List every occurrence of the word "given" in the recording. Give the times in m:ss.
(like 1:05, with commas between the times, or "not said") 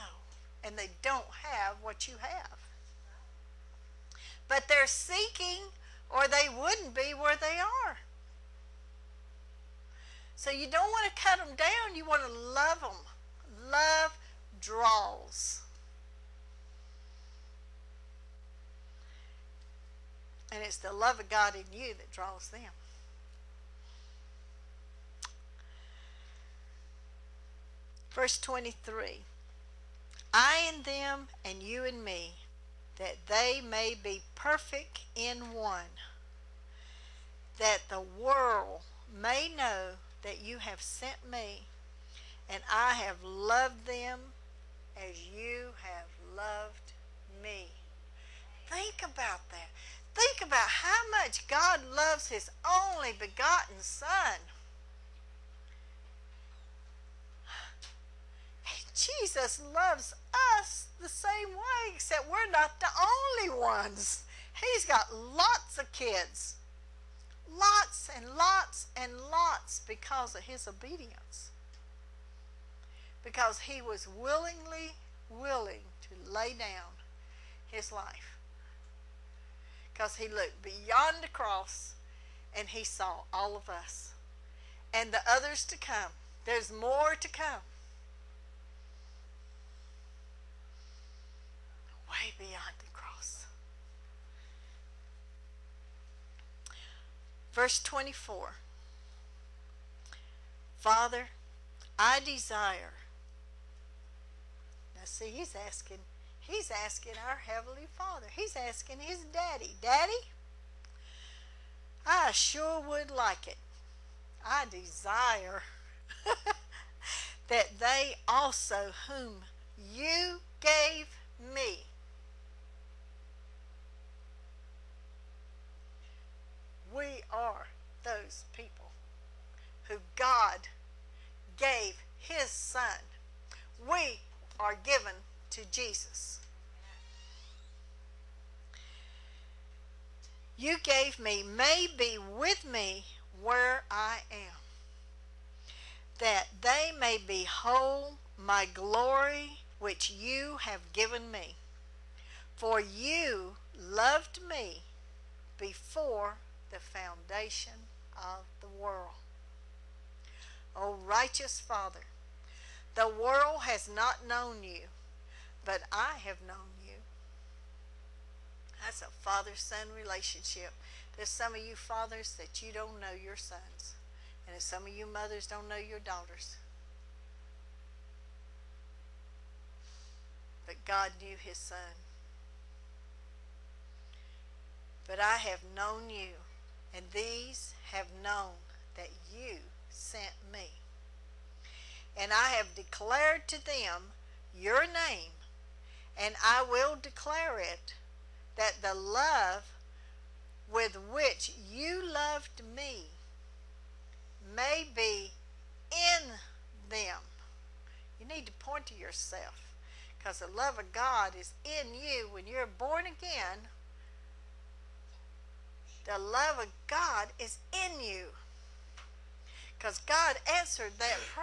2:14, 2:30.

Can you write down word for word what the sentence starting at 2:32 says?
For you loved me before the foundation of the world.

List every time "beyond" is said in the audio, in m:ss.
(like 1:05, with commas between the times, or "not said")
1:20, 1:32.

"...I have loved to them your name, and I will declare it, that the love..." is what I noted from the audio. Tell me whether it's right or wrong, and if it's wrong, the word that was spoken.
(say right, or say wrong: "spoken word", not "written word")
wrong: "declared", not "loved".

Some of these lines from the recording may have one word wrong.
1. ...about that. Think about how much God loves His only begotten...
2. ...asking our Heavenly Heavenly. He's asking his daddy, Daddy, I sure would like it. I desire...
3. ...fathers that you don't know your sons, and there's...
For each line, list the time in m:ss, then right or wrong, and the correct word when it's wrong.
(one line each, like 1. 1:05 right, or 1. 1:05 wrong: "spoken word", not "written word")
1. 0:49 right
2. 1:46 wrong: "Father", not "Heavenly"
3. 2:51 right.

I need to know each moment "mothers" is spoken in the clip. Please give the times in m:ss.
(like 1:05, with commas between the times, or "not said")
2:55.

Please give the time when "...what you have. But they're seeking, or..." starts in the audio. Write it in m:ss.
0:01.